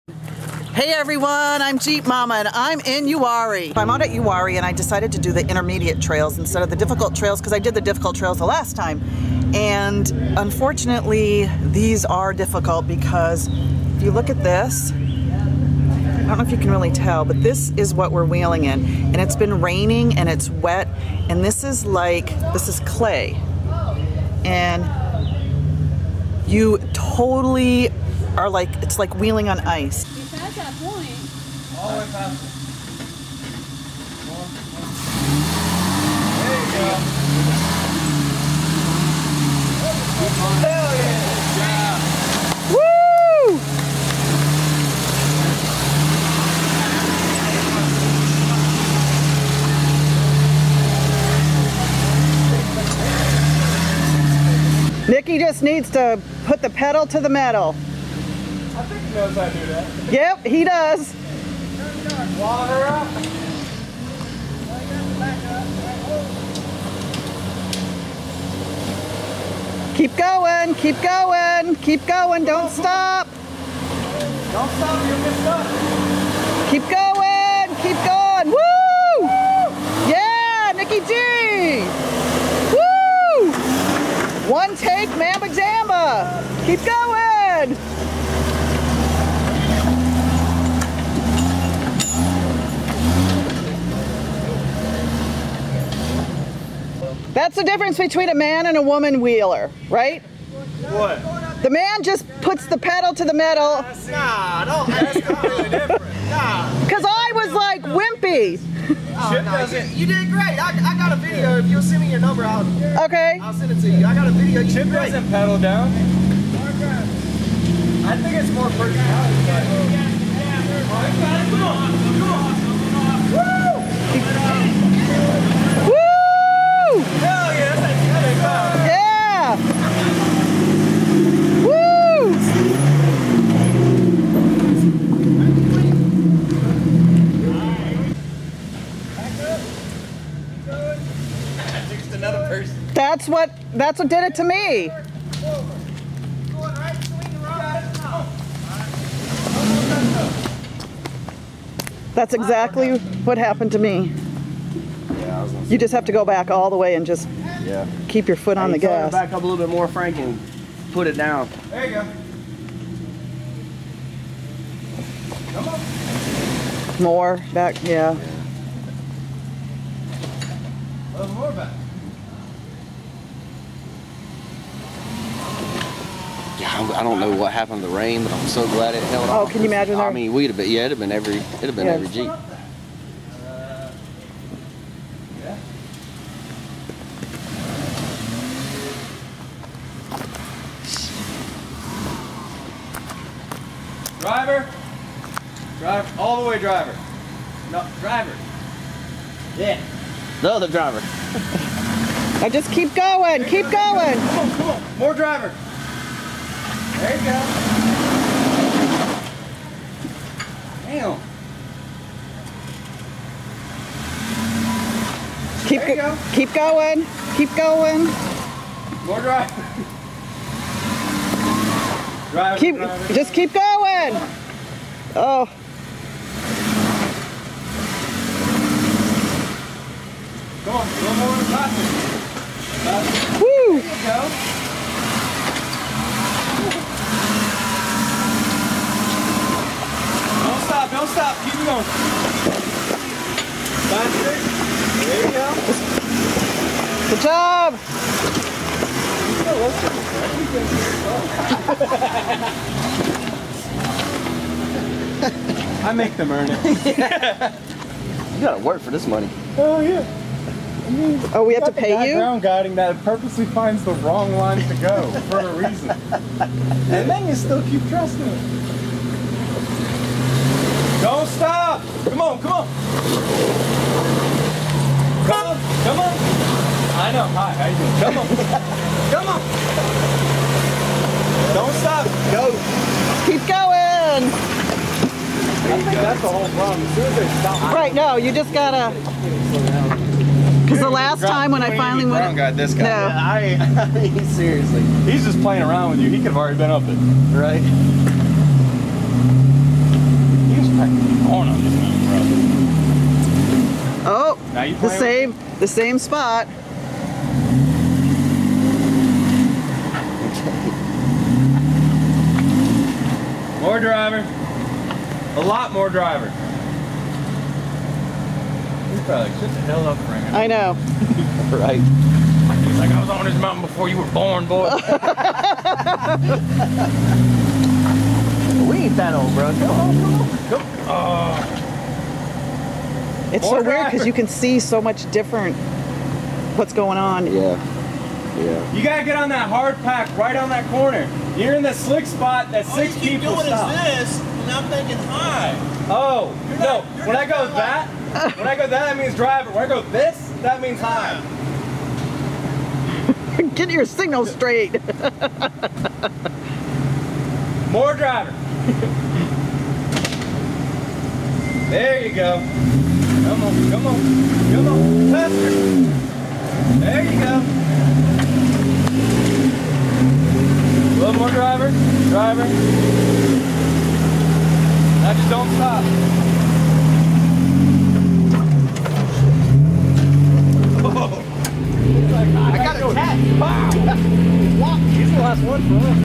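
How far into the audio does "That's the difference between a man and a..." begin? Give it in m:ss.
1:37.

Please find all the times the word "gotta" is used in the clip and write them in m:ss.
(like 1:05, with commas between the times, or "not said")
4:18, 4:48, 5:38.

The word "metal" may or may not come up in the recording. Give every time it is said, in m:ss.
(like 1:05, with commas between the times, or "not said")
0:57, 1:43.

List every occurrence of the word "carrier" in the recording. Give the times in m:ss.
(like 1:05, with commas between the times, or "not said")
not said.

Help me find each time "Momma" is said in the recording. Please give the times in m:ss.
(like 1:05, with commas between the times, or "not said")
0:02.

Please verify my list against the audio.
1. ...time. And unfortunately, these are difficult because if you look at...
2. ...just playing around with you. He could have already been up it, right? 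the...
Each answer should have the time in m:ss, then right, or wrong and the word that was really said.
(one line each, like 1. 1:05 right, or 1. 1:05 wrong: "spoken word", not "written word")
1. 0:08 right
2. 4:55 right.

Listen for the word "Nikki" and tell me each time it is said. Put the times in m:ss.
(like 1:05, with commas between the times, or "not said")
0:55, 1:20.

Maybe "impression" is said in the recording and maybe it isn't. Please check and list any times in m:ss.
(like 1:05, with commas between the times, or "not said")
not said.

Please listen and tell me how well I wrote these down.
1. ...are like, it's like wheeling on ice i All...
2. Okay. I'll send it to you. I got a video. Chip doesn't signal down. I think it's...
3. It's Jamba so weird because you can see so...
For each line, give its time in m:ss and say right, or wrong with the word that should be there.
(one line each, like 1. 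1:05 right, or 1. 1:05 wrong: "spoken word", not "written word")
1. 0:28 right
2. 1:53 wrong: "pedal", not "signal"
3. 5:33 wrong: "More", not "Jamba".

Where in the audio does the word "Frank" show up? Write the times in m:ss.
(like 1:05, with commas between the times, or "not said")
2:39, 5:19.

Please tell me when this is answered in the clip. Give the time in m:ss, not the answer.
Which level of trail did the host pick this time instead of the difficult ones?
0:05.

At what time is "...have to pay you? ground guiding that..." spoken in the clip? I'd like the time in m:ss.
4:21.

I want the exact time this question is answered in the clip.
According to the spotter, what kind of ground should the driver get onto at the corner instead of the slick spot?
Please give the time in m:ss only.
5:39.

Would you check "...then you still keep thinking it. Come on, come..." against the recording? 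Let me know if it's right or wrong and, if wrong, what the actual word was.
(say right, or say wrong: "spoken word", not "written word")
wrong: "trusting", not "thinking".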